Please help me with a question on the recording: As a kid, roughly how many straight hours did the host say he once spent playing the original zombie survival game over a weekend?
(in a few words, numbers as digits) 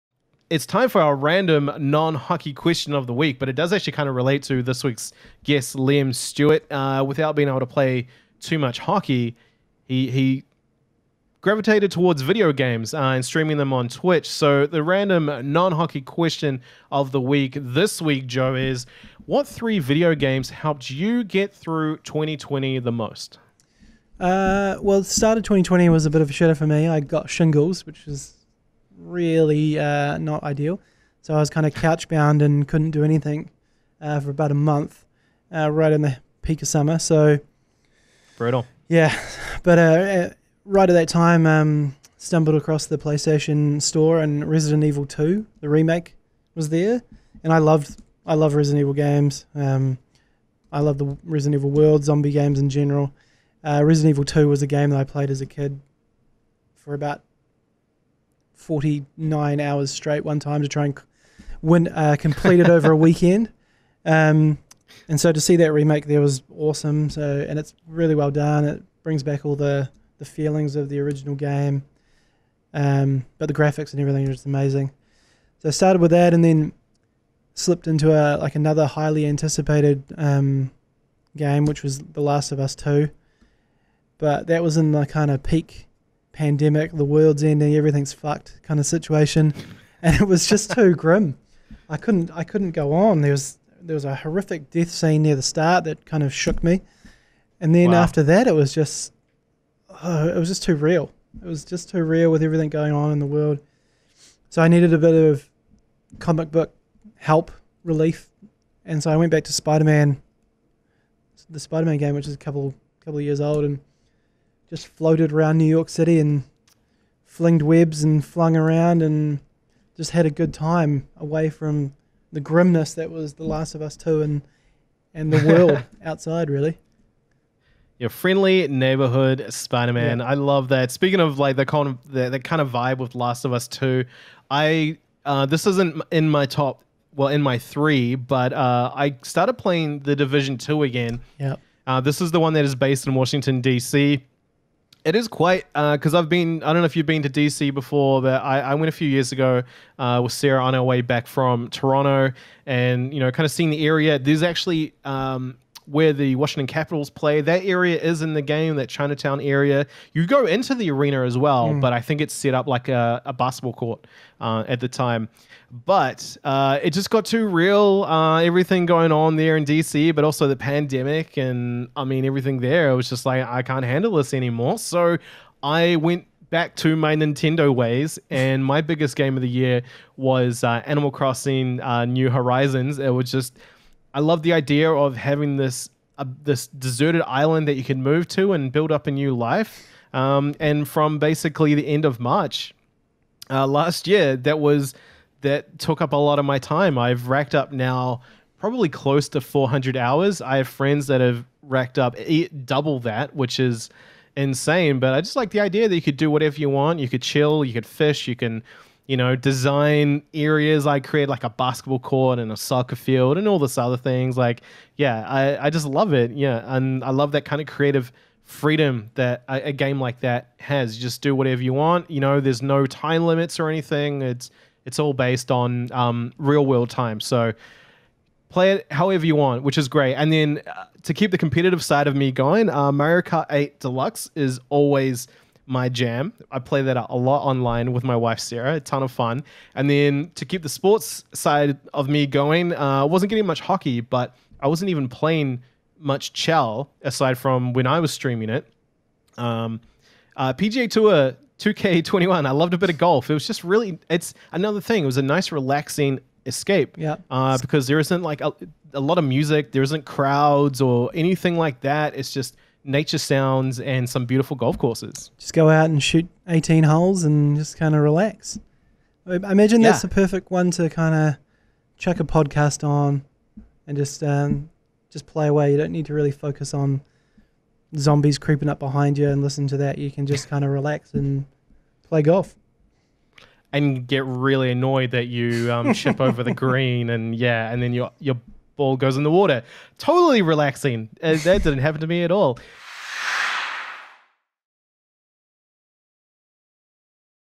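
49.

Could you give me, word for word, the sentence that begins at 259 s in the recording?
There isn't crowds or anything like that.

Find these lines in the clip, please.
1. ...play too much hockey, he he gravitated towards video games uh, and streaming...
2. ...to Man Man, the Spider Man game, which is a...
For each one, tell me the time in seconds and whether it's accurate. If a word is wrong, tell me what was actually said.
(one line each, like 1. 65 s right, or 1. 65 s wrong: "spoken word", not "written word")
1. 7 s right
2. 109 s wrong: "Spider", not "Man".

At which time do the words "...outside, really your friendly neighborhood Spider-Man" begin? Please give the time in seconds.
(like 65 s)
126 s.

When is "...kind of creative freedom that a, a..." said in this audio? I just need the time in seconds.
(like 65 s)
217 s.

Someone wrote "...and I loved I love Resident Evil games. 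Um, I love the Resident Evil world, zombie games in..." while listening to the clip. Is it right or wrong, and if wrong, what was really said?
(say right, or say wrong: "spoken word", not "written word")
right.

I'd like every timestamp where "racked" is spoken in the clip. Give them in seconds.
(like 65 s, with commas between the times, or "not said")
197 s, 201 s.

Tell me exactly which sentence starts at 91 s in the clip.
I couldn't I couldn't go on.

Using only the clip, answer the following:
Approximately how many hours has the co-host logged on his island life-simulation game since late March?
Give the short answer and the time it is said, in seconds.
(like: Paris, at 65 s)
400, at 199 s.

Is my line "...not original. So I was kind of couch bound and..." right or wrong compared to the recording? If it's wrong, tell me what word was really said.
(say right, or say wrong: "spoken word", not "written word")
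wrong: "ideal", not "original".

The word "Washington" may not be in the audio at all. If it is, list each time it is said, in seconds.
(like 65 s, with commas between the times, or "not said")
143 s, 156 s.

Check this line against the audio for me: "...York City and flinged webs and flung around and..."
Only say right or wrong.
right.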